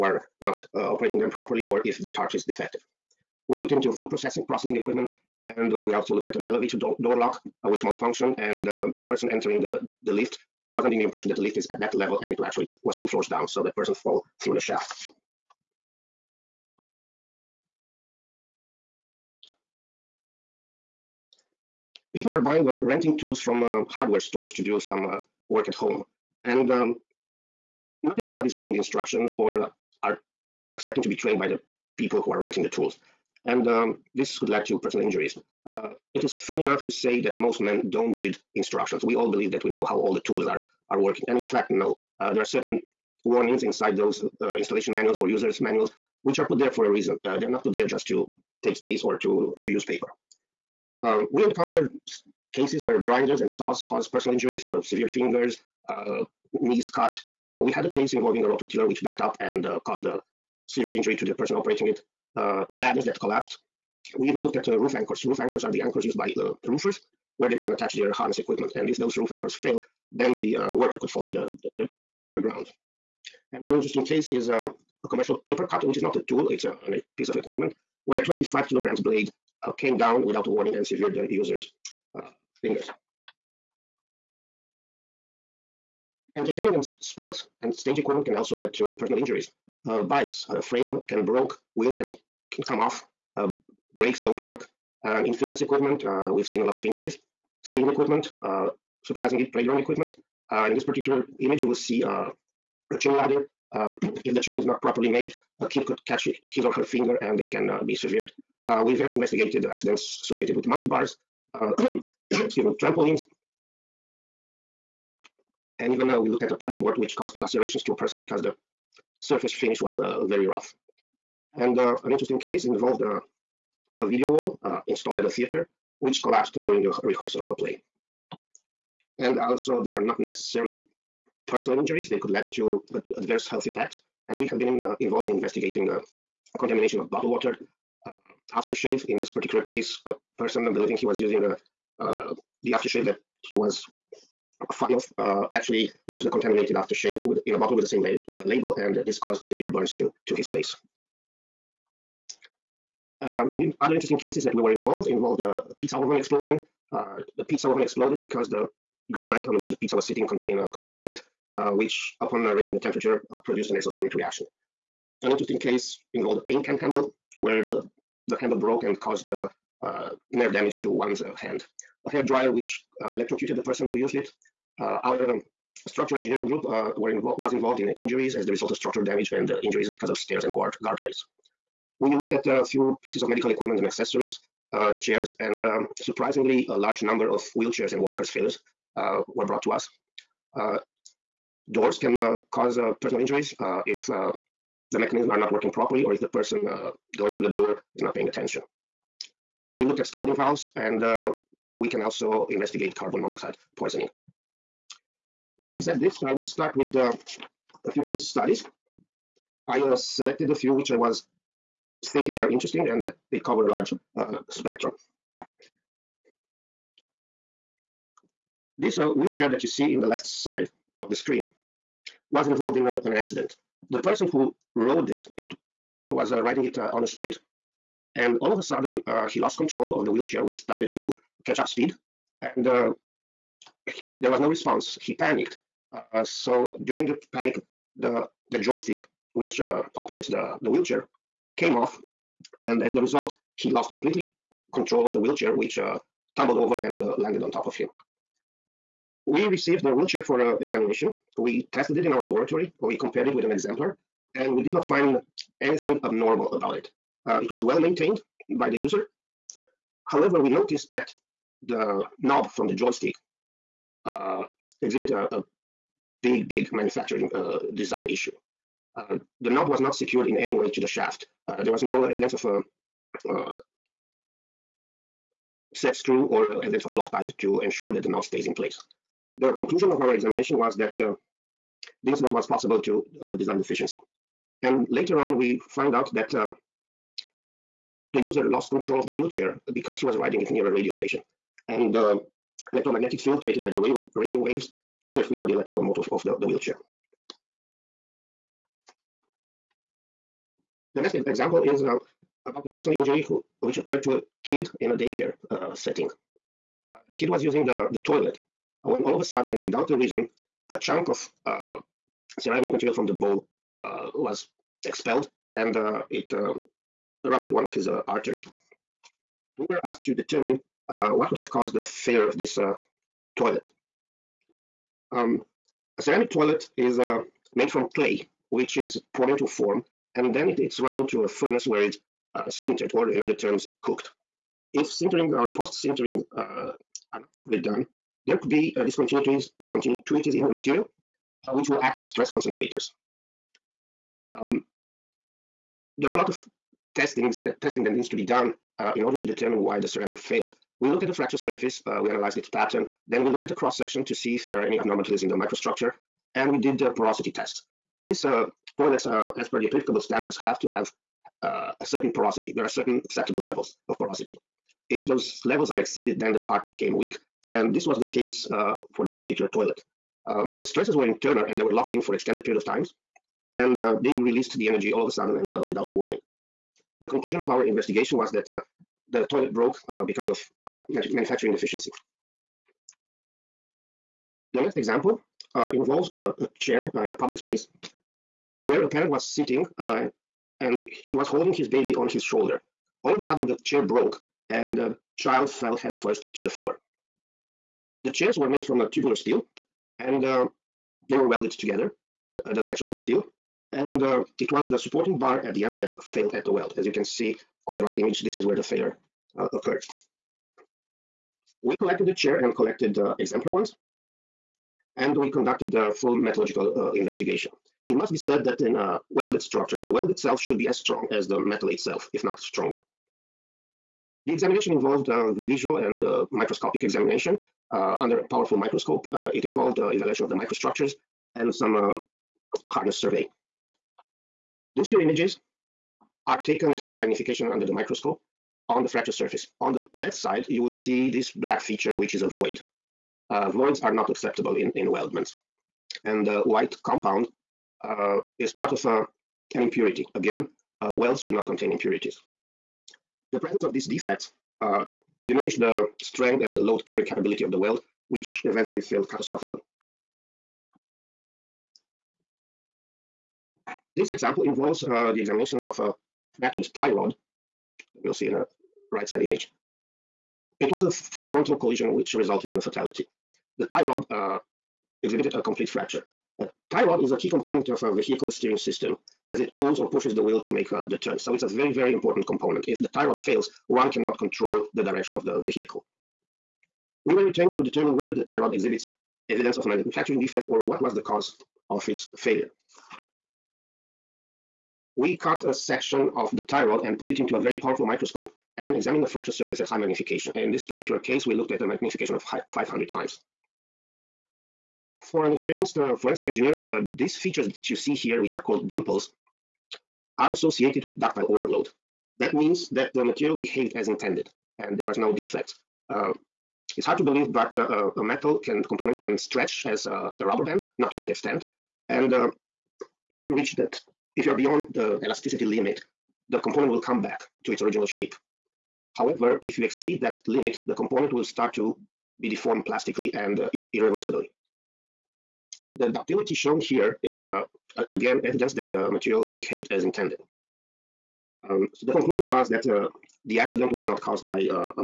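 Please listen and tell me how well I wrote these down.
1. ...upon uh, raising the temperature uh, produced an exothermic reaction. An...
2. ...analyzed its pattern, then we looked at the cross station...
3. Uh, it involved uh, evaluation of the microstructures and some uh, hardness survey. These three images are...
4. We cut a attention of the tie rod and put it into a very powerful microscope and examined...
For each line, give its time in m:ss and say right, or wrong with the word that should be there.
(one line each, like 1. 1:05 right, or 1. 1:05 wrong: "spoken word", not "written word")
1. 2:42 right
2. 5:52 wrong: "section", not "station"
3. 7:09 wrong: "two", not "three"
4. 8:14 wrong: "section", not "attention".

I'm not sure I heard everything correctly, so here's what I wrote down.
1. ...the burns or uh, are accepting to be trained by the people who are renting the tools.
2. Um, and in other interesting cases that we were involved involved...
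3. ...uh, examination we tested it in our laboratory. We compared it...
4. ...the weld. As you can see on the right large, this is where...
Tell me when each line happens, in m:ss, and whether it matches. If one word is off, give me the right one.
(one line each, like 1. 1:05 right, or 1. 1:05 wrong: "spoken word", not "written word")
1. 0:28 wrong: "instructions", not "burns"
2. 2:33 right
3. 4:10 right
4. 6:46 wrong: "image", not "large".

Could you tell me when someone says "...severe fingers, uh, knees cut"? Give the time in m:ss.
0:54.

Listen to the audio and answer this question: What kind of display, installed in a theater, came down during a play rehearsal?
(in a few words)
video wall.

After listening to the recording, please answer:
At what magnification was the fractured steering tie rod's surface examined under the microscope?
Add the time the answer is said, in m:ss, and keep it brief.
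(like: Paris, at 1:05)
500 times, at 8:22.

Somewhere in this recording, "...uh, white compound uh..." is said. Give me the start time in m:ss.
7:26.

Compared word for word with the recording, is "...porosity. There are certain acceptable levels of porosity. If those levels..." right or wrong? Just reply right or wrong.
right.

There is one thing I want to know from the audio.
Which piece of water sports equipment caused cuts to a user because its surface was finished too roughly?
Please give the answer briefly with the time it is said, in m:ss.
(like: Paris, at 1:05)
paddleboard, at 1:56.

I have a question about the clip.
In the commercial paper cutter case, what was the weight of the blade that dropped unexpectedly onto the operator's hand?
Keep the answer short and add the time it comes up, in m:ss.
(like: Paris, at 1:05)
25 kilograms, at 1:18.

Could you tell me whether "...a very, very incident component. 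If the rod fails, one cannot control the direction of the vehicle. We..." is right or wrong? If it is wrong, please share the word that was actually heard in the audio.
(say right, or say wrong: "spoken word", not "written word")
wrong: "important", not "incident".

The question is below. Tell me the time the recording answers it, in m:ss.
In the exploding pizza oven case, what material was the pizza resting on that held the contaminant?
2:39.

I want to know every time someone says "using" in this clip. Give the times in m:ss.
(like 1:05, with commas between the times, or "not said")
2:21, 5:07.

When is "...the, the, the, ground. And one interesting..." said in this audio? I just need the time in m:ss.
1:11.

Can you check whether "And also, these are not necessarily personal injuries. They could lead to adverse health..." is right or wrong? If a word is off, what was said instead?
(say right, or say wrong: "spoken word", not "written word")
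right.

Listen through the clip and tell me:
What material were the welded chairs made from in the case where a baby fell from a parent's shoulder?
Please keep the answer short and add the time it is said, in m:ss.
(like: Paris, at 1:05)
tubular steel, at 6:38.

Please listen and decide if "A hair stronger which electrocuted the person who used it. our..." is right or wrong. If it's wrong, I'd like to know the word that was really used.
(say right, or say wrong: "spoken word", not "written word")
wrong: "dryer", not "stronger".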